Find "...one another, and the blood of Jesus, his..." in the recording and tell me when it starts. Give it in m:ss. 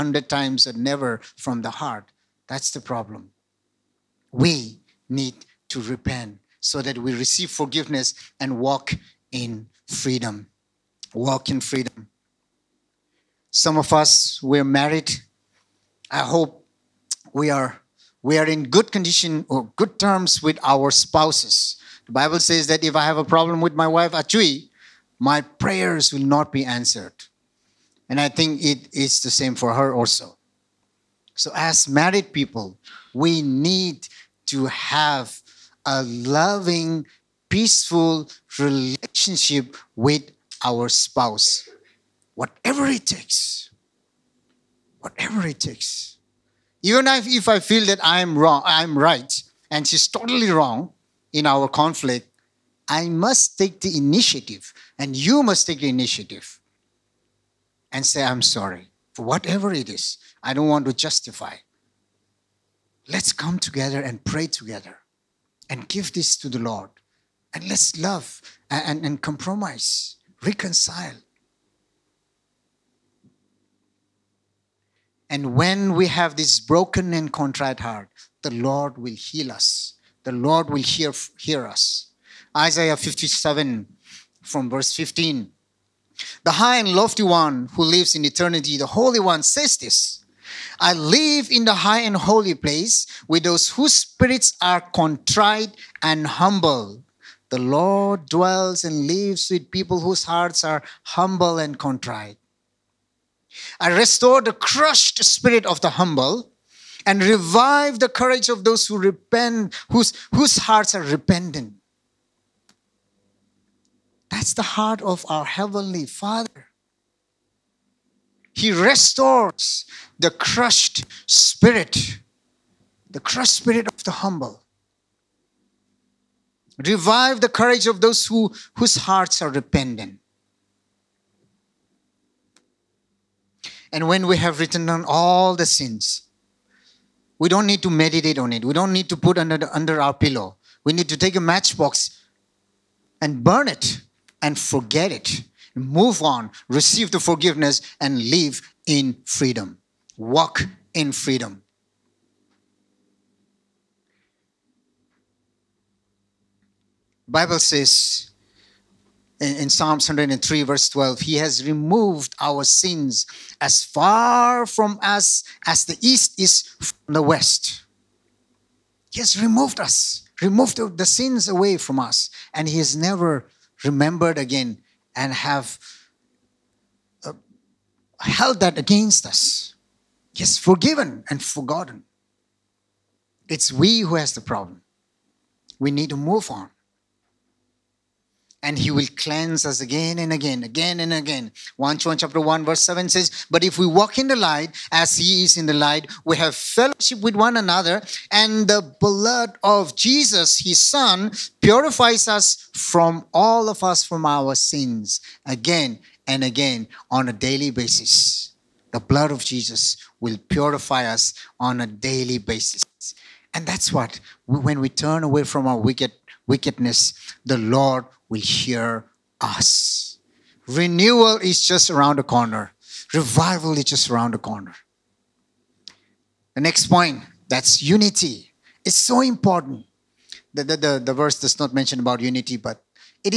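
3:17.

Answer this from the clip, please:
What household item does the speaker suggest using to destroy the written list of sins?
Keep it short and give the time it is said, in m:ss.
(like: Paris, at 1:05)
A matchbox, at 2:21.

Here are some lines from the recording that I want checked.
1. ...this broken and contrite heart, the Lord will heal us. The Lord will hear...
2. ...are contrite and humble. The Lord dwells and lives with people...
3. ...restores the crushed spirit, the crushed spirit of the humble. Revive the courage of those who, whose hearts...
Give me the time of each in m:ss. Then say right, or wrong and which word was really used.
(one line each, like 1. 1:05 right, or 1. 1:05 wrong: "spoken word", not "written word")
1. 1:16 right
2. 1:34 right
3. 1:58 right.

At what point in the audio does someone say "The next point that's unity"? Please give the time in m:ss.
3:46.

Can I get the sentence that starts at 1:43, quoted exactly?
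I restore the crushed spirit of the humble and revive the courage of those who repent, whose, whose hearts are repentant.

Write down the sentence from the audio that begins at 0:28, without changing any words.
And I think it is the same for her also.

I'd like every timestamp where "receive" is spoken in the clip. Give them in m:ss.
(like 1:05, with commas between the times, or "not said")
0:07, 2:26.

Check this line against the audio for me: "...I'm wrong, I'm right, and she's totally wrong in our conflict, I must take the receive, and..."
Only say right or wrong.
wrong.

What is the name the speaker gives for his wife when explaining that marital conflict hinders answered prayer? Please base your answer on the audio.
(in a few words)
Achui.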